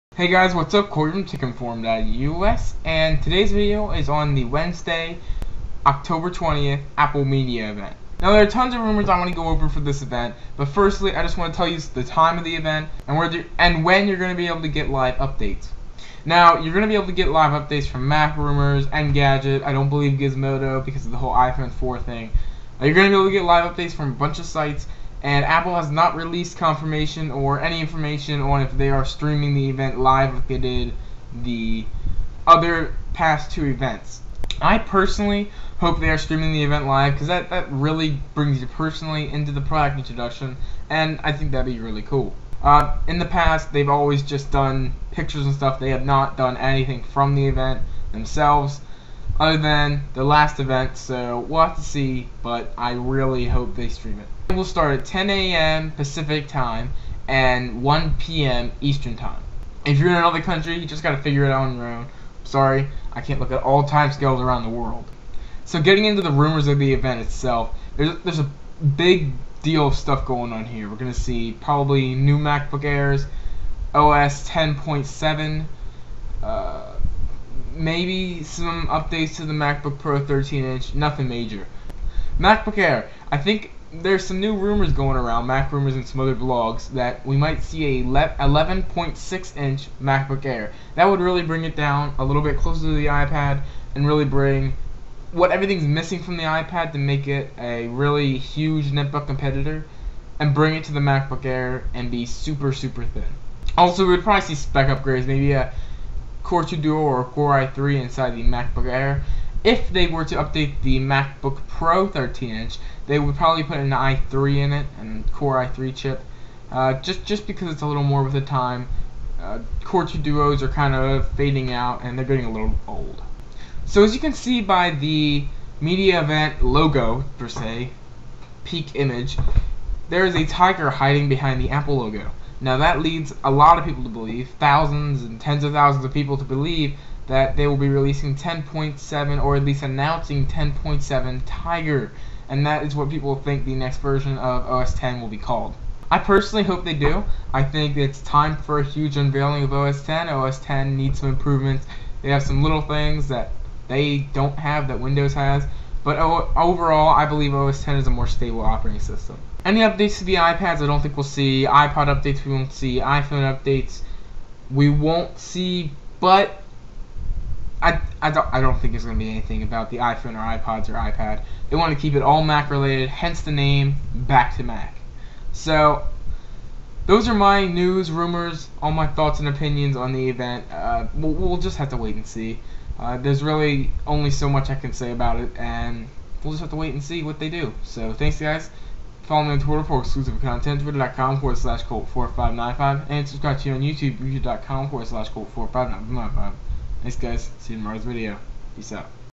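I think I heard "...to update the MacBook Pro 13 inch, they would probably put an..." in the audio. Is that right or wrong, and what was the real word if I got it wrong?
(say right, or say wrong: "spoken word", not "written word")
right.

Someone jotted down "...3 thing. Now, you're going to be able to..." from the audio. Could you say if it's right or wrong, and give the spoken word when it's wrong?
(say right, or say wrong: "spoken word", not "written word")
wrong: "4", not "3".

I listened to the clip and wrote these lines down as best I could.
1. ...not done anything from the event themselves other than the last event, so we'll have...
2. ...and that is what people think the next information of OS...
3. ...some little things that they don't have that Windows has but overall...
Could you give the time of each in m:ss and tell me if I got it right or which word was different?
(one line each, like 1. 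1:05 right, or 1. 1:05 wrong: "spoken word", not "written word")
1. 0:46 right
2. 2:22 wrong: "version", not "information"
3. 2:32 right.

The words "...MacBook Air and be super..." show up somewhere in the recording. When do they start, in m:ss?
1:40.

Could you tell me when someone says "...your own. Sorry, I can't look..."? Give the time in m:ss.
1:01.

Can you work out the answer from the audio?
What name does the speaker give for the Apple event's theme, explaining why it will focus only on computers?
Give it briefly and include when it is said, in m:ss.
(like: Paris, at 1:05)
Back to Mac, at 2:54.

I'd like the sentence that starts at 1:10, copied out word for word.
We're gonna see probably new MacBook Airs, OS 10.7, uh, maybe some updates to the MacBook Pro 13 inch, nothing major.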